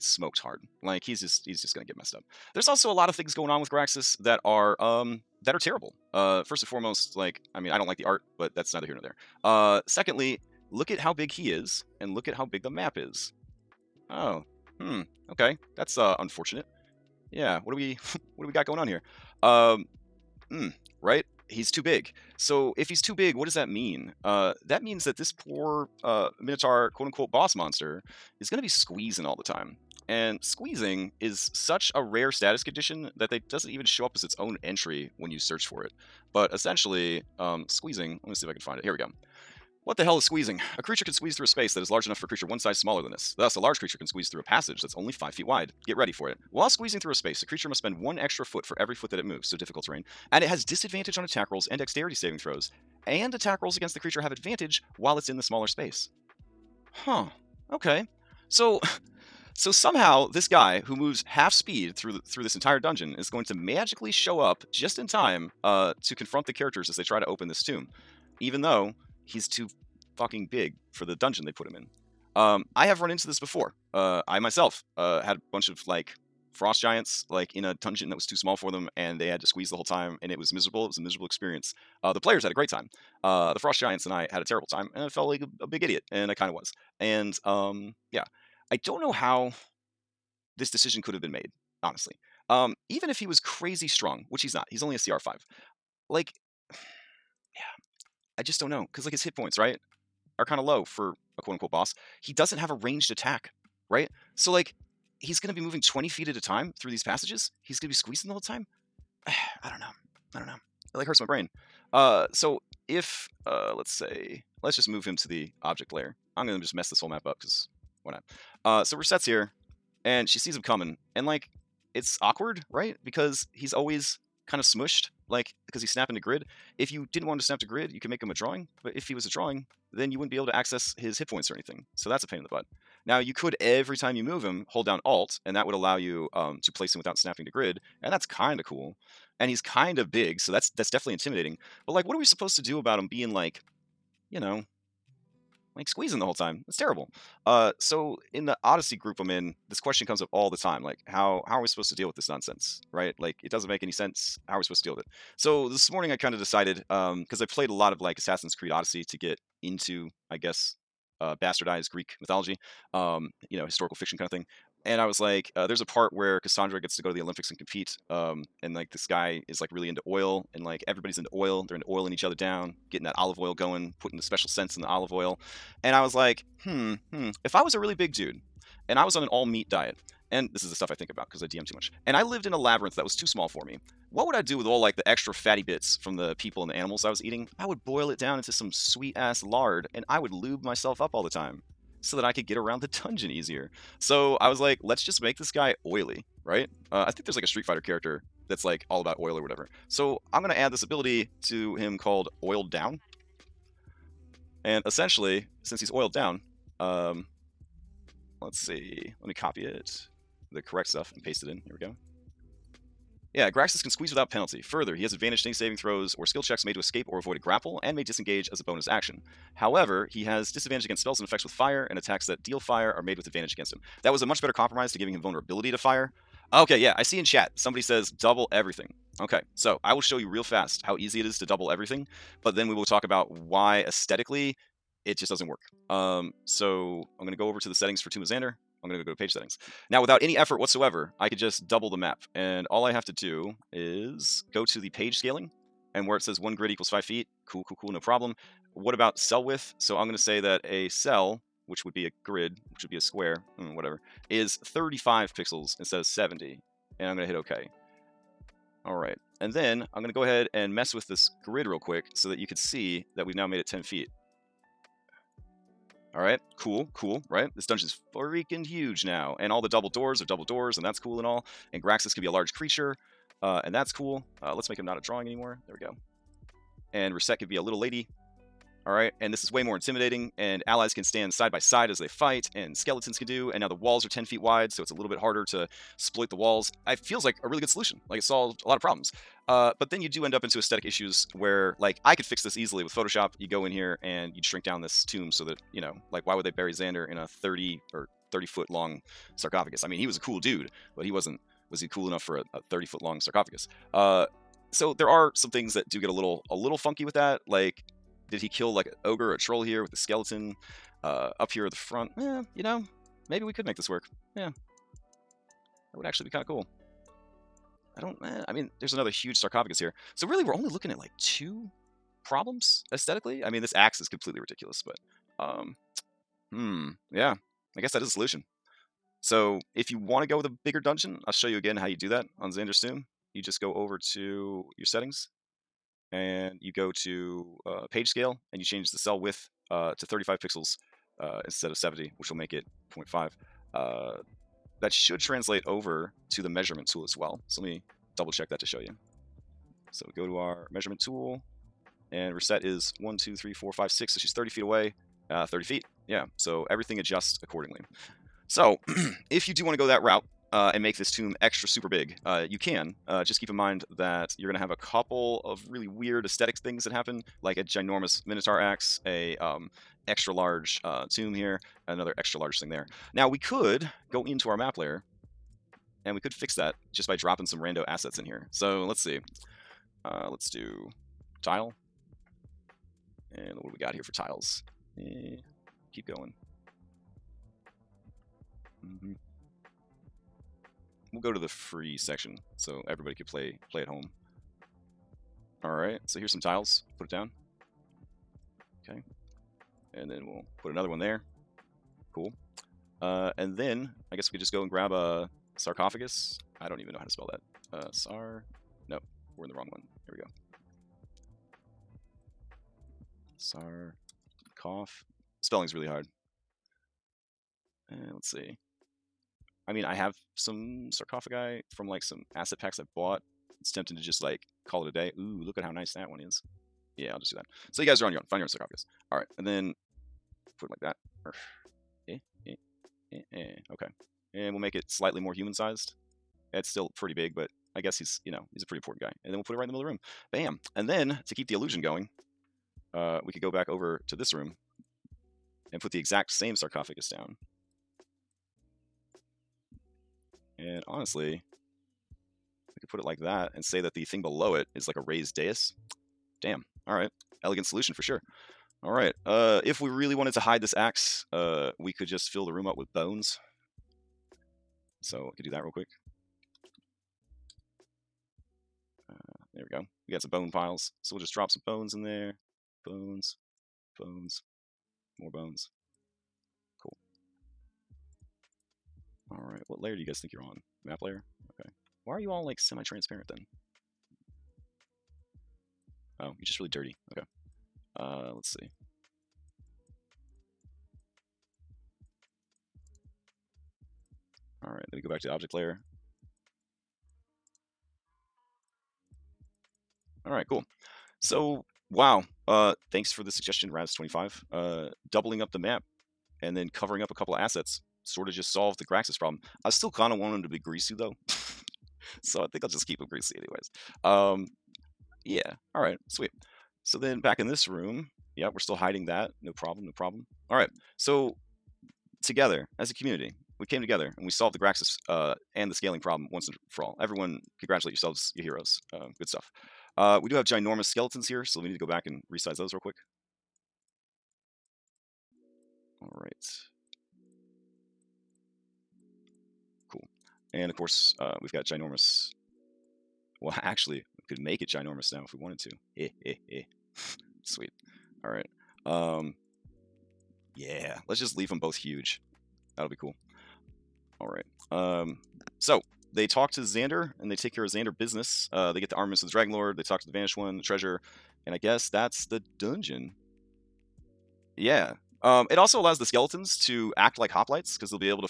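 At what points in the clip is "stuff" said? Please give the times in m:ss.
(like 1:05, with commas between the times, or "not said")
3:00, 3:30, 8:49.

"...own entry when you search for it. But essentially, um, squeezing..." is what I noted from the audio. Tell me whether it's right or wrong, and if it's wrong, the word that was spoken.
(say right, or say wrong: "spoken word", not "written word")
right.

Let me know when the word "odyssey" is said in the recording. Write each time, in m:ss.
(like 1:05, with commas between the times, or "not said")
2:28, 2:38.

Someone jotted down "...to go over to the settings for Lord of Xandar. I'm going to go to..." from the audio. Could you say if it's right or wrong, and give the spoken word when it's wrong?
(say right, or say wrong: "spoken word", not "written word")
wrong: "Tomb", not "Lord".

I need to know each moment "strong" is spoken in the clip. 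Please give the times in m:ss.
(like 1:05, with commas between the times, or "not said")
1:33.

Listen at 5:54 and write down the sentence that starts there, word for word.
So she's 30 feet away, uh, 30 feet yeah, so everything adjusts accordingly.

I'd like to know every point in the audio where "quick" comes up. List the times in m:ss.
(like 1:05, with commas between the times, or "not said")
4:21, 7:45, 8:52.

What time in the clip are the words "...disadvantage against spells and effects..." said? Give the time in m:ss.
3:40.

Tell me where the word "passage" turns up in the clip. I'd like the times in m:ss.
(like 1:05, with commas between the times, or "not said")
0:44, 1:47.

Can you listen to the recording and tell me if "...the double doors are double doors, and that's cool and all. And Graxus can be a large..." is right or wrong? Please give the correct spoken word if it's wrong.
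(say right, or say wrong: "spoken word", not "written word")
right.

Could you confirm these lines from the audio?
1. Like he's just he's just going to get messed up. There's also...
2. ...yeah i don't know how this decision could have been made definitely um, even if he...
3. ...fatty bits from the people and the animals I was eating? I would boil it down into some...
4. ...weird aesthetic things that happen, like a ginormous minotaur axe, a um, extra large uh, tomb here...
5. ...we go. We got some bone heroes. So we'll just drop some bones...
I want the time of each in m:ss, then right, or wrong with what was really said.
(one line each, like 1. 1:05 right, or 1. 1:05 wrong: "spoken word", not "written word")
1. 0:00 right
2. 1:28 wrong: "honestly", not "definitely"
3. 3:05 right
4. 6:05 right
5. 7:49 wrong: "piles", not "heroes".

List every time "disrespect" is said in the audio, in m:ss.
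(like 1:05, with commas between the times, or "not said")
not said.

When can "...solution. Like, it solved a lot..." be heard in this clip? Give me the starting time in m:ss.
4:47.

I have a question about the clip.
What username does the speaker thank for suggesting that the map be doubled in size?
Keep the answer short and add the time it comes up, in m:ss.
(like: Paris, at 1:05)
Raz25, at 8:23.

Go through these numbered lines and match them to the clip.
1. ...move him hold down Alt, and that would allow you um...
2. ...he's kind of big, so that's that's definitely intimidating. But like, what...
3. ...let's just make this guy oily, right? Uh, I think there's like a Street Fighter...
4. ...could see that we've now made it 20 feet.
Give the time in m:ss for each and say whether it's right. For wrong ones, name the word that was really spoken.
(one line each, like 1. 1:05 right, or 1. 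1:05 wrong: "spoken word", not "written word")
1. 2:14 right
2. 2:19 right
3. 3:14 right
4. 4:22 wrong: "10", not "20".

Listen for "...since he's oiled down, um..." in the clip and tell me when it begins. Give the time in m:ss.
3:25.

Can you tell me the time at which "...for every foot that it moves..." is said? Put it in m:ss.
0:48.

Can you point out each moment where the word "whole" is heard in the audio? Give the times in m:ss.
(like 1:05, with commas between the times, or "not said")
1:19, 1:48, 1:57, 2:26.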